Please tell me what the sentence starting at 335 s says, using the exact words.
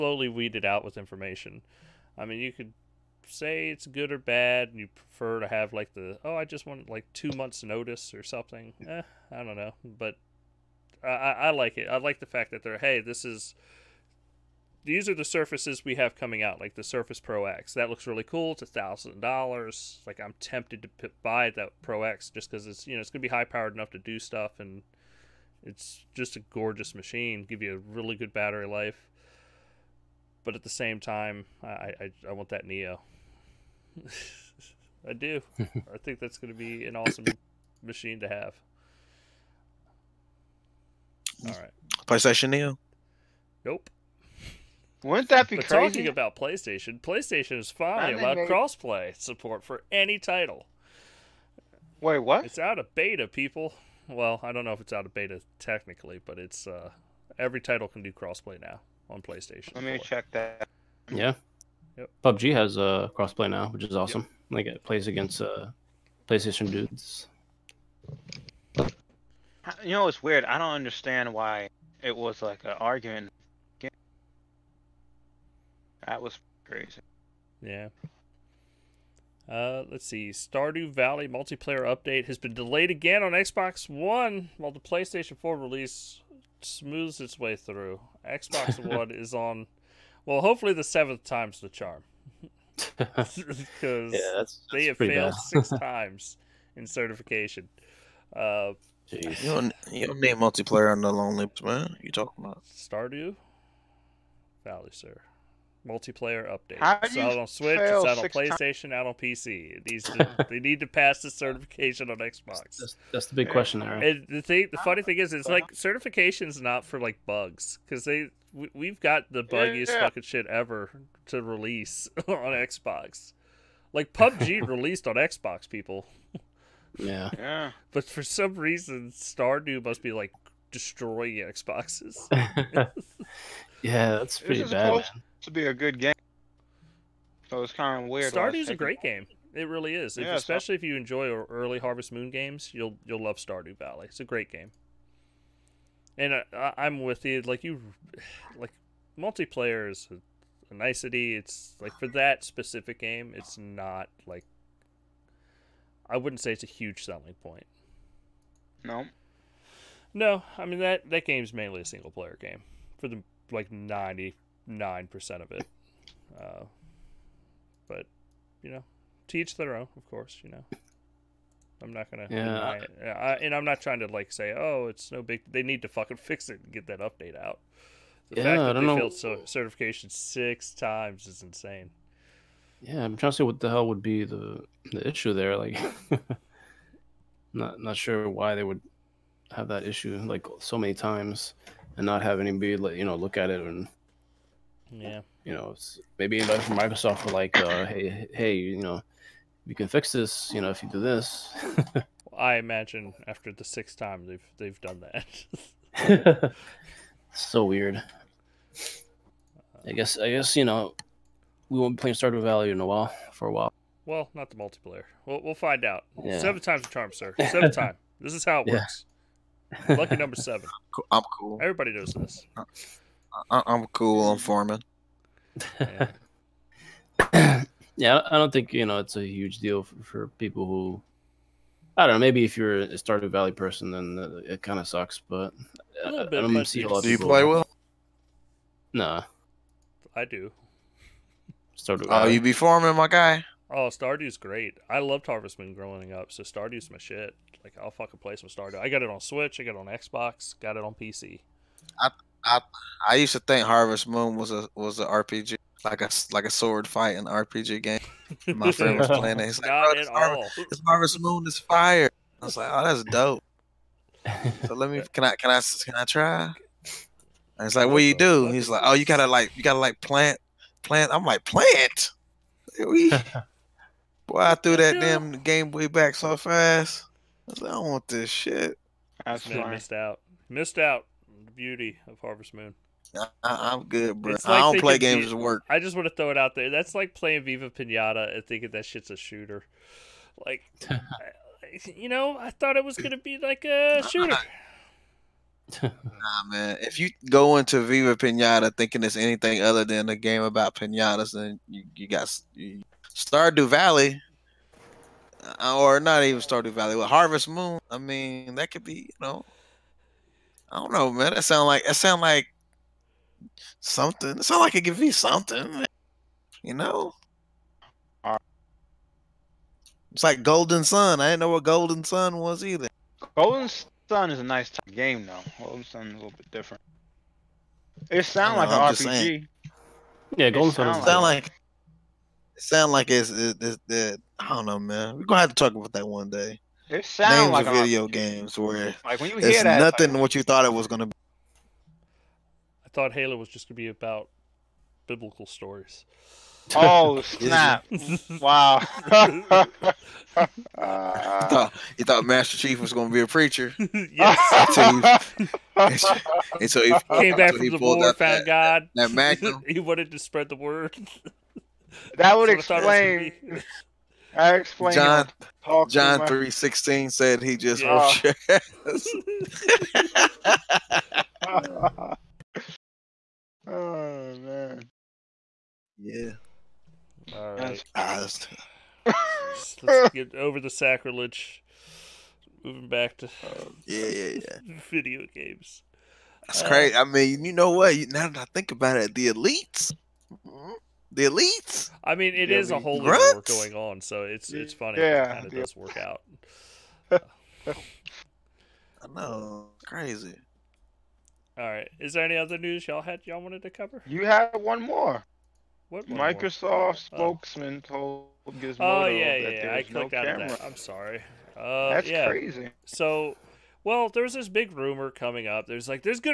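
We're gonna have to talk about that one day.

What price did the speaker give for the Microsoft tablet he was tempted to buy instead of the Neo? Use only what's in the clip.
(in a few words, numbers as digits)
$1,000.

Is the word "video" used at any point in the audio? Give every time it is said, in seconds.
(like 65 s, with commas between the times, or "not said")
337 s, 384 s.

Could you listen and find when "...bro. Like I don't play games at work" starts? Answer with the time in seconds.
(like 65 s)
284 s.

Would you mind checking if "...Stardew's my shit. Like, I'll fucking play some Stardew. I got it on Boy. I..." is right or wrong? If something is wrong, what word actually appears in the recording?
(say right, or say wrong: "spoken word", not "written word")
wrong: "Switch", not "Boy".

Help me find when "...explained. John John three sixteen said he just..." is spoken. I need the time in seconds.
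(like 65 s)
364 s.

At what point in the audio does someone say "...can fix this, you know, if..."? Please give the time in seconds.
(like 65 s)
199 s.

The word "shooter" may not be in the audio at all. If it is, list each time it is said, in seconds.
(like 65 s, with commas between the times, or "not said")
289 s, 294 s.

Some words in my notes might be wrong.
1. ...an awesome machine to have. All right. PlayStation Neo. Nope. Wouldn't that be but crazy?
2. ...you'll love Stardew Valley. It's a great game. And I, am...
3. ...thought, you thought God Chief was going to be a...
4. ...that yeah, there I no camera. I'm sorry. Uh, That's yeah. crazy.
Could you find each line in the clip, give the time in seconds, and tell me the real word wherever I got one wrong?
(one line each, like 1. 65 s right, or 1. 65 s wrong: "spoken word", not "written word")
1. 36 s right
2. 143 s right
3. 350 s wrong: "Master", not "God"
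4. 409 s right.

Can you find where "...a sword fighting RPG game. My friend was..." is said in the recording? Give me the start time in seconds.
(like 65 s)
256 s.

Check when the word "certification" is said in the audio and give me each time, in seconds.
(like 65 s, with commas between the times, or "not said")
96 s, 111 s, 115 s, 179 s.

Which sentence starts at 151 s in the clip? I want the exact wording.
It's like for that specific game, it's not like.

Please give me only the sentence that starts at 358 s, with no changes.
That, that he wanted to spread the word.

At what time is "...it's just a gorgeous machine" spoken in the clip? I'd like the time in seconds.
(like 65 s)
25 s.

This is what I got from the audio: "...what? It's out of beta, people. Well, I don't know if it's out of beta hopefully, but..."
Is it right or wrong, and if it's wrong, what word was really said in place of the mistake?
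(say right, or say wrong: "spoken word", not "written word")
wrong: "technically", not "hopefully".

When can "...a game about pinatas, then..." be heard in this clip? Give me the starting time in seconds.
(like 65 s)
300 s.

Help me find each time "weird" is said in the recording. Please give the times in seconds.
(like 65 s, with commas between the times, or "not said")
70 s, 138 s, 207 s.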